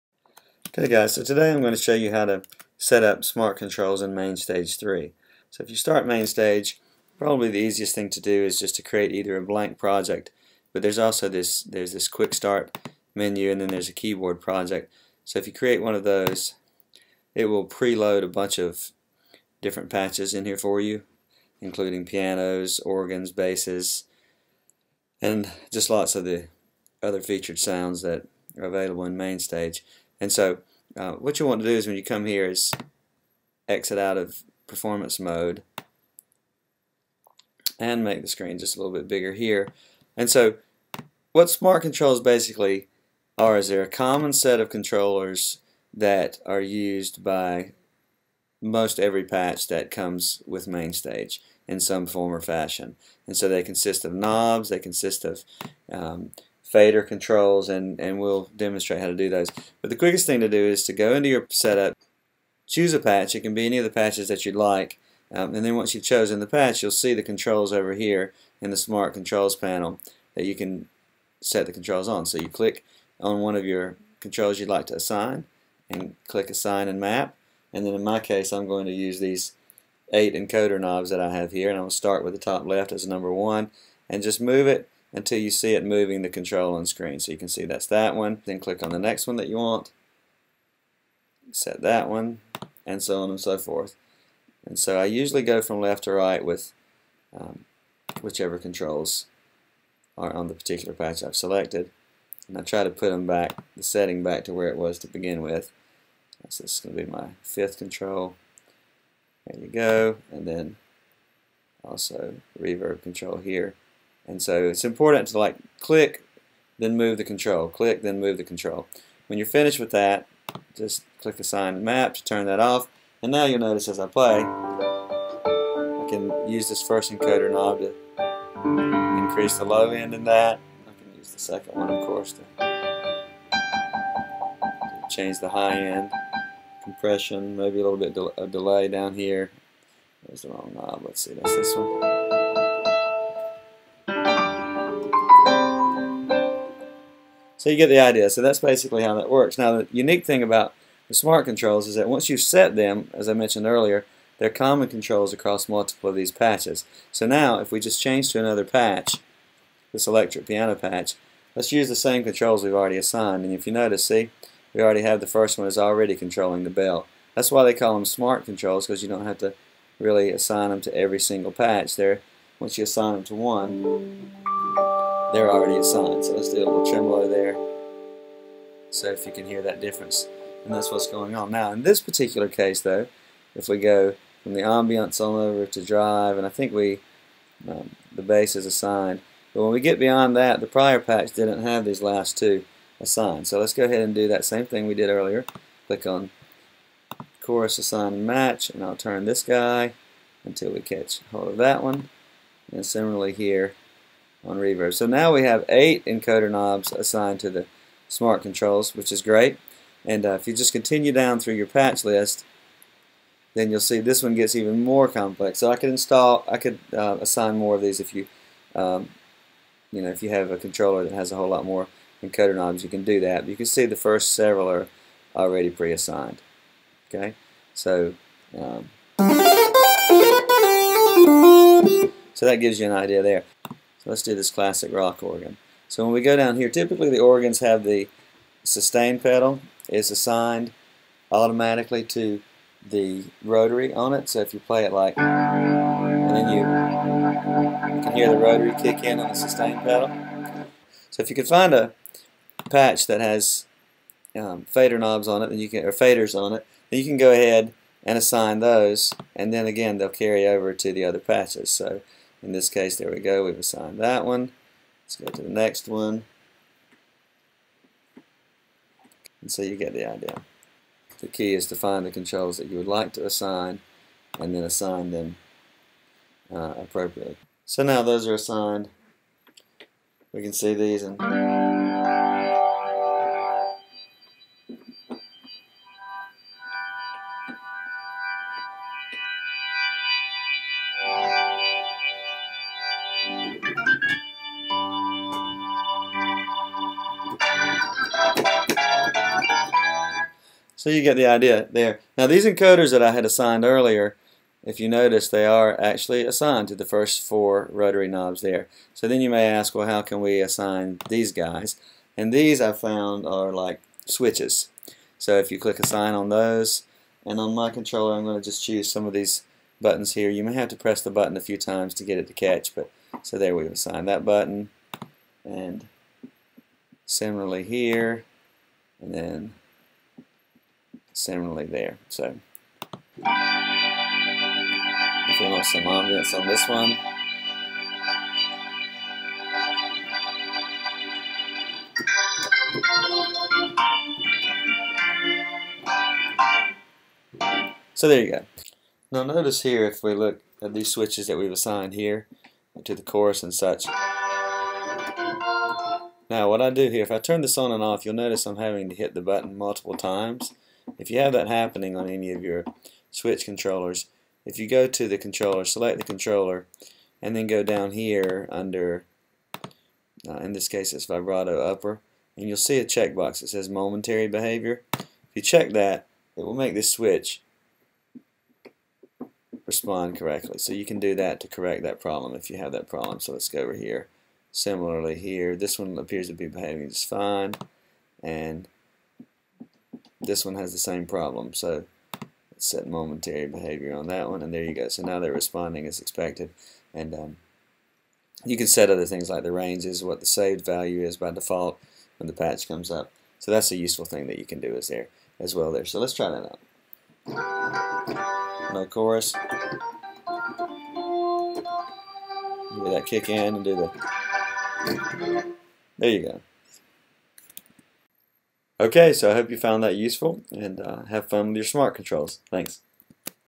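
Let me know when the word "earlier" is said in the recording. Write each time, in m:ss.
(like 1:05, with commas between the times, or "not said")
2:33, 3:15, 5:03.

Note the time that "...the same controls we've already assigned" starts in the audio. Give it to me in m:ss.
2:41.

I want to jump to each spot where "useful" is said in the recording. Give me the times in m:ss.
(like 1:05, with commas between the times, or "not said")
6:43, 6:59.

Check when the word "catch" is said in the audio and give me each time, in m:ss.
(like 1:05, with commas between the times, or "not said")
3:20, 5:22.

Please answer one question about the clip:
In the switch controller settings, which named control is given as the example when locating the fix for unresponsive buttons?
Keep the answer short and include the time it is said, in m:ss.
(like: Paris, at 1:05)
Vibrato upper, at 6:11.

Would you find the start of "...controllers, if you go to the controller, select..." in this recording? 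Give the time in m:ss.
6:03.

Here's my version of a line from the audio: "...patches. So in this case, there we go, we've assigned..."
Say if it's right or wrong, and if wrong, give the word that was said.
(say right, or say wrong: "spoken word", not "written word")
right.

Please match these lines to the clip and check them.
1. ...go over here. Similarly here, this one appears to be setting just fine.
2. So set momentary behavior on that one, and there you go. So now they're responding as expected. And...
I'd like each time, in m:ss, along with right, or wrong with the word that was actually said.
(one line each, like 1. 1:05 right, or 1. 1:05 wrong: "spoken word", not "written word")
1. 6:23 wrong: "behaving", not "setting"
2. 6:31 right.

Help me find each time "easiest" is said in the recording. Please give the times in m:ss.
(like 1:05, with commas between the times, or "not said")
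0:07.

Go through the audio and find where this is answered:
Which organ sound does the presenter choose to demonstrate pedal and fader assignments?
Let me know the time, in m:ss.
3:54.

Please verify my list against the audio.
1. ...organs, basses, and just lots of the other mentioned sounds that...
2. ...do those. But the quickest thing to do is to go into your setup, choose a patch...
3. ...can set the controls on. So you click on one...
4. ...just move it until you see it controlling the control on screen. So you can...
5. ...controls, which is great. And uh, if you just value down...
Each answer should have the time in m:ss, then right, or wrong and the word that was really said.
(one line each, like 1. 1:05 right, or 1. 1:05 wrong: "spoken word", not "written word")
1. 0:22 wrong: "featured", not "mentioned"
2. 0:59 right
3. 1:10 right
4. 1:24 wrong: "moving", not "controlling"
5. 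3:28 wrong: "continue", not "value".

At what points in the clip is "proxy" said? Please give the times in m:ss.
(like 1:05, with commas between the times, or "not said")
not said.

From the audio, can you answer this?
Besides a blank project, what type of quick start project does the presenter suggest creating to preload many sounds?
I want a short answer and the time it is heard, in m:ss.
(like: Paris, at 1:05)
Keyboard project, at 0:13.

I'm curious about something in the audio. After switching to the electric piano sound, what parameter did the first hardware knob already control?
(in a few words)
Bell.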